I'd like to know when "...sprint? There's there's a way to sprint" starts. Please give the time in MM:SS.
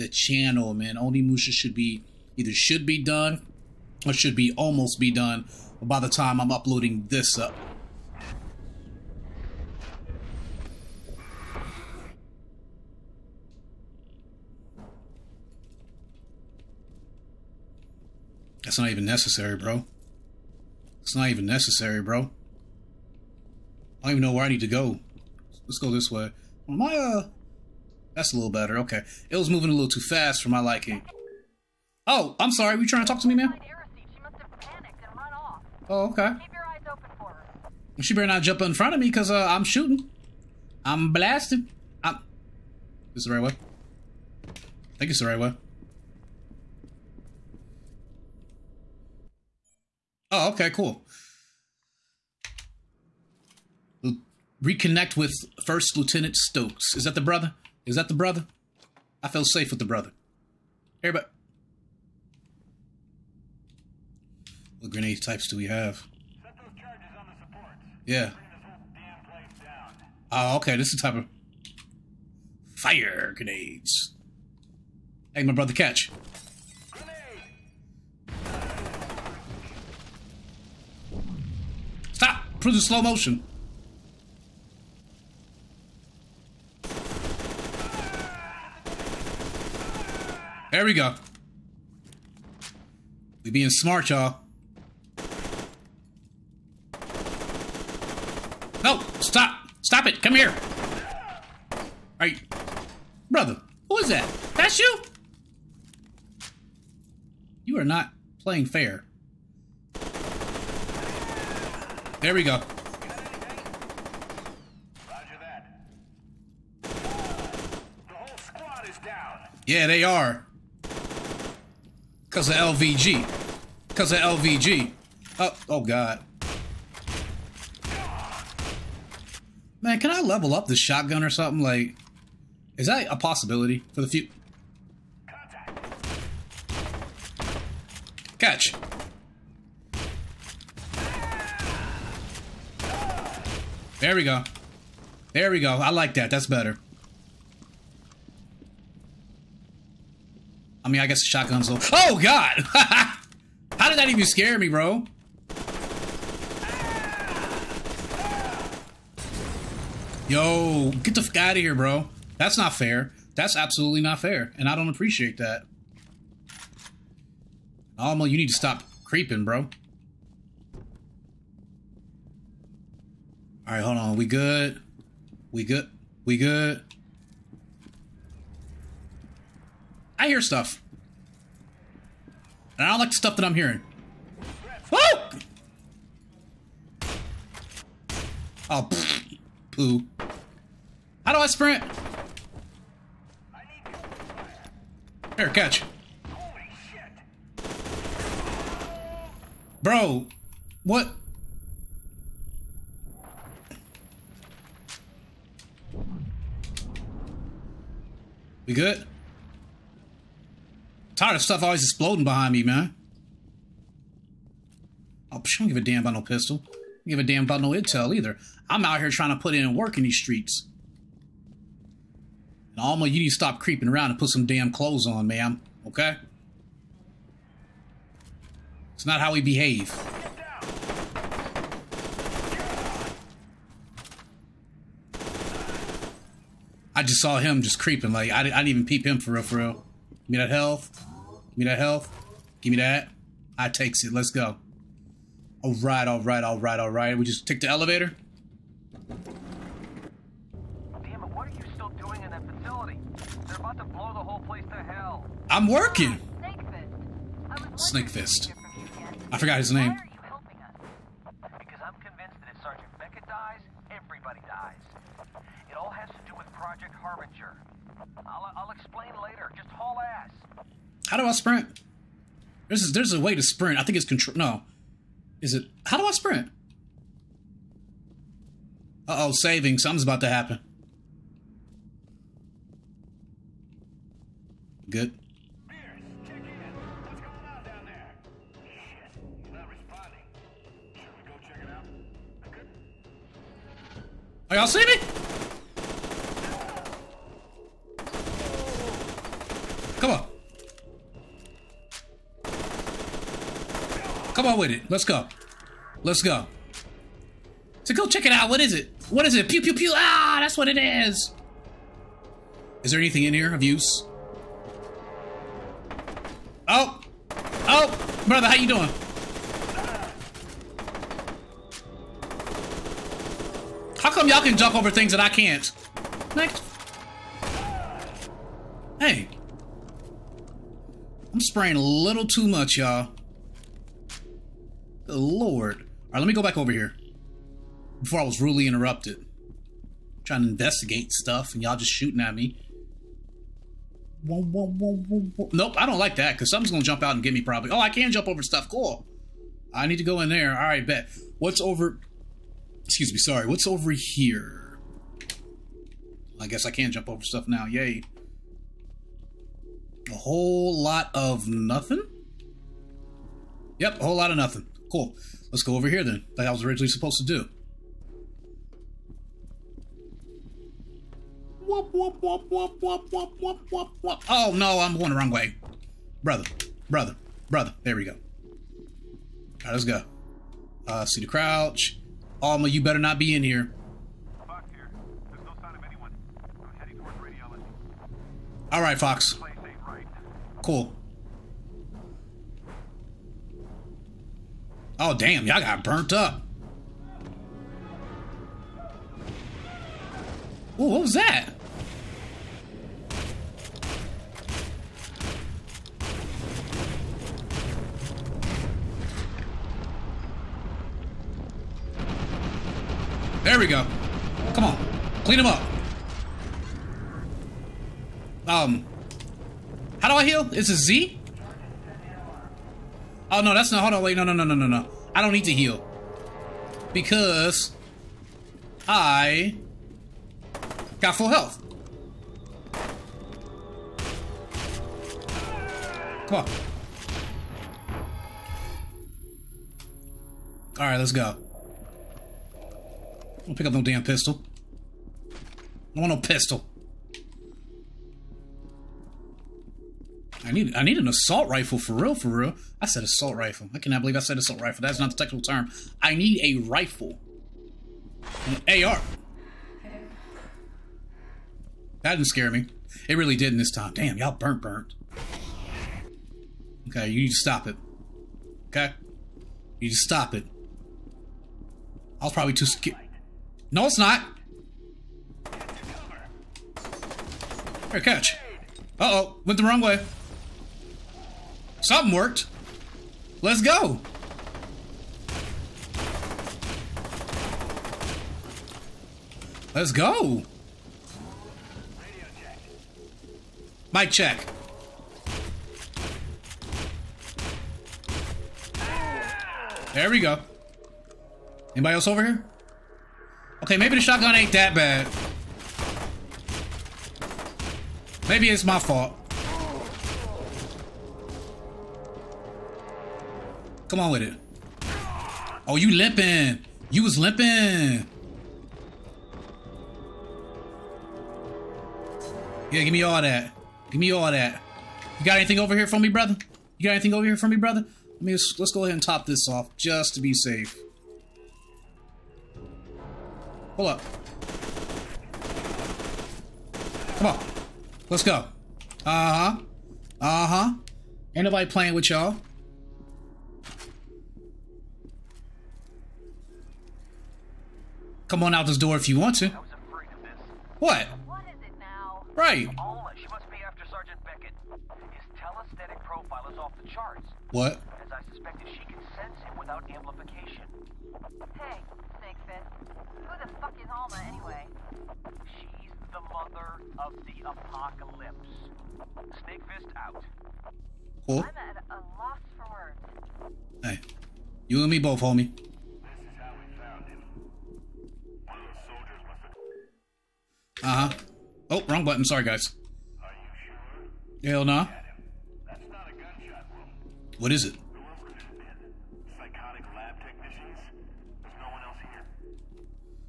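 04:31.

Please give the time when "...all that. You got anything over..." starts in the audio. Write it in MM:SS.
08:44.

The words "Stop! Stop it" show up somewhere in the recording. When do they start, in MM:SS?
01:39.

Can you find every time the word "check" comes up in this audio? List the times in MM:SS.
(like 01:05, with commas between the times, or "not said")
05:08, 08:14.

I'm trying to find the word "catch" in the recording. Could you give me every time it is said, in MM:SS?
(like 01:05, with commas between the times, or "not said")
01:15, 02:18, 03:15, 07:58.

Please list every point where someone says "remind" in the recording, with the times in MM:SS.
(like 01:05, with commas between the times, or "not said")
not said.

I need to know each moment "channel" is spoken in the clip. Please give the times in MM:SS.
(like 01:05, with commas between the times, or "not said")
00:00.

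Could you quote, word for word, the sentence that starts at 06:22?
Alma, you better not be in here.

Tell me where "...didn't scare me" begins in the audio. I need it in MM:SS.
07:42.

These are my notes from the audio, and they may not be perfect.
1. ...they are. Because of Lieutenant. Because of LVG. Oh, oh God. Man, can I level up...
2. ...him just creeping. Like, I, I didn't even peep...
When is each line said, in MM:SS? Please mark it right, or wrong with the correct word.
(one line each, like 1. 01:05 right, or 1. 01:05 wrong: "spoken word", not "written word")
1. 01:59 wrong: "LVG", not "Lieutenant"
2. 03:57 right.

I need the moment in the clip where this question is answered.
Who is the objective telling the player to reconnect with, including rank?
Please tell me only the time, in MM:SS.
00:55.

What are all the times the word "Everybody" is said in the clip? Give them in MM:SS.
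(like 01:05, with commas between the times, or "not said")
01:01.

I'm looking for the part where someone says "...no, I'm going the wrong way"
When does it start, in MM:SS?
06:14.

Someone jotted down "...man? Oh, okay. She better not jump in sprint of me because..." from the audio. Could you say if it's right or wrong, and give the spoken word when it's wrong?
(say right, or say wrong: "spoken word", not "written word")
wrong: "front", not "sprint".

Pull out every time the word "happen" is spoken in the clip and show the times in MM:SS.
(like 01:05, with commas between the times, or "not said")
04:40.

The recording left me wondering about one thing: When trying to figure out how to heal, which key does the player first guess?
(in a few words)
Z.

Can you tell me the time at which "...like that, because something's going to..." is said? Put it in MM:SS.
05:45.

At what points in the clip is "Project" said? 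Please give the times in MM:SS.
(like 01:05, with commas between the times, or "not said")
04:26.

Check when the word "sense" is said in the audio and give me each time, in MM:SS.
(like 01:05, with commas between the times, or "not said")
09:19.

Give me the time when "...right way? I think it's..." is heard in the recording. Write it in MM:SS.
00:43.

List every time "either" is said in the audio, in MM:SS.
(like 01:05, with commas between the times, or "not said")
00:02, 03:38.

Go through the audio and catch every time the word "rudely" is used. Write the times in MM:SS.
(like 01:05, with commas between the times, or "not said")
05:38.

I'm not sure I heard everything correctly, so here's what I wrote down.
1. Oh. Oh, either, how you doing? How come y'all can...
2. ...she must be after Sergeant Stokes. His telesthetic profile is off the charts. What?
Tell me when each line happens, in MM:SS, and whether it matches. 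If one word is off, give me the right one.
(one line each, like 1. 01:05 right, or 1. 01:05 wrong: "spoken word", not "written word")
1. 05:16 wrong: "brother", not "either"
2. 09:13 wrong: "Becket", not "Stokes".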